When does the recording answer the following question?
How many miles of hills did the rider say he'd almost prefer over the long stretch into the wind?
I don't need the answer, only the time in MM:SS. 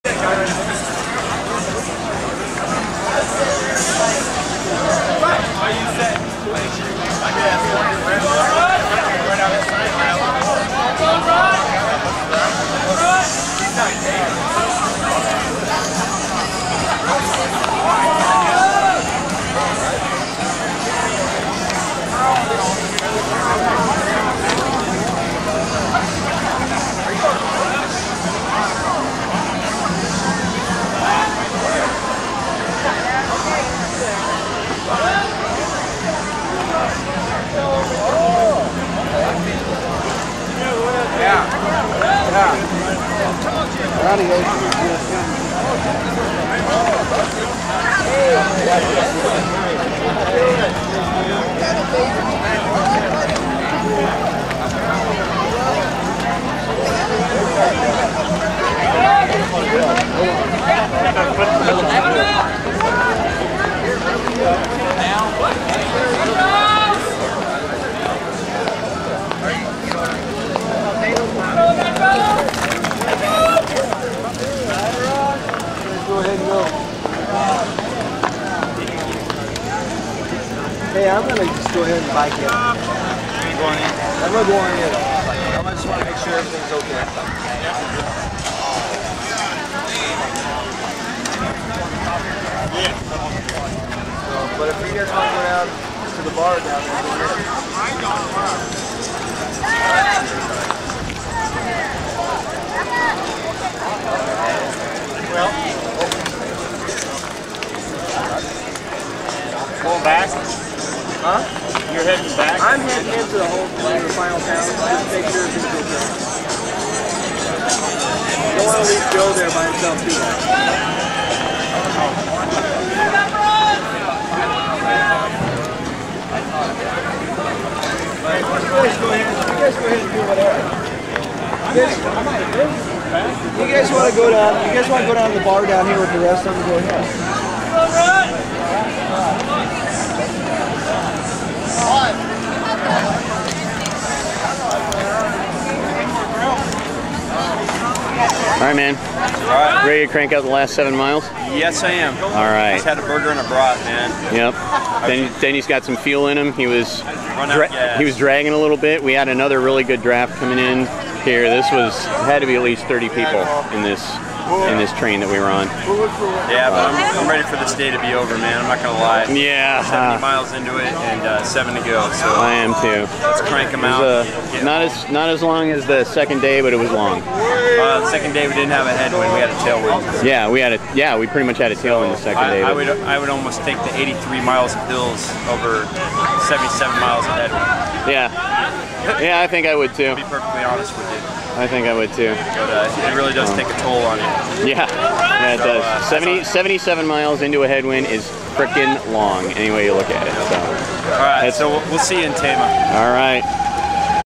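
03:03.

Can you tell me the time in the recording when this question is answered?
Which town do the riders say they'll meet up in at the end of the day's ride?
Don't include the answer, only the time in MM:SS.
03:22.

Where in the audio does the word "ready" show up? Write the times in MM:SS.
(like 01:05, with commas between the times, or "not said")
02:29, 02:47.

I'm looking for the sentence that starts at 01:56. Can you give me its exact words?
Don't want to leave Joe there by himself too much.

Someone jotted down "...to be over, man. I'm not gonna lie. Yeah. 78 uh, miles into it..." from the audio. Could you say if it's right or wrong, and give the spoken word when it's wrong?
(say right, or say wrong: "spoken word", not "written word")
wrong: "70", not "78".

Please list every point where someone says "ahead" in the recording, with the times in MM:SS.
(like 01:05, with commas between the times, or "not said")
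01:21, 02:09, 02:16.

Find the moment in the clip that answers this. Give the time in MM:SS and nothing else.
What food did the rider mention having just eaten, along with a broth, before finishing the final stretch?
02:33.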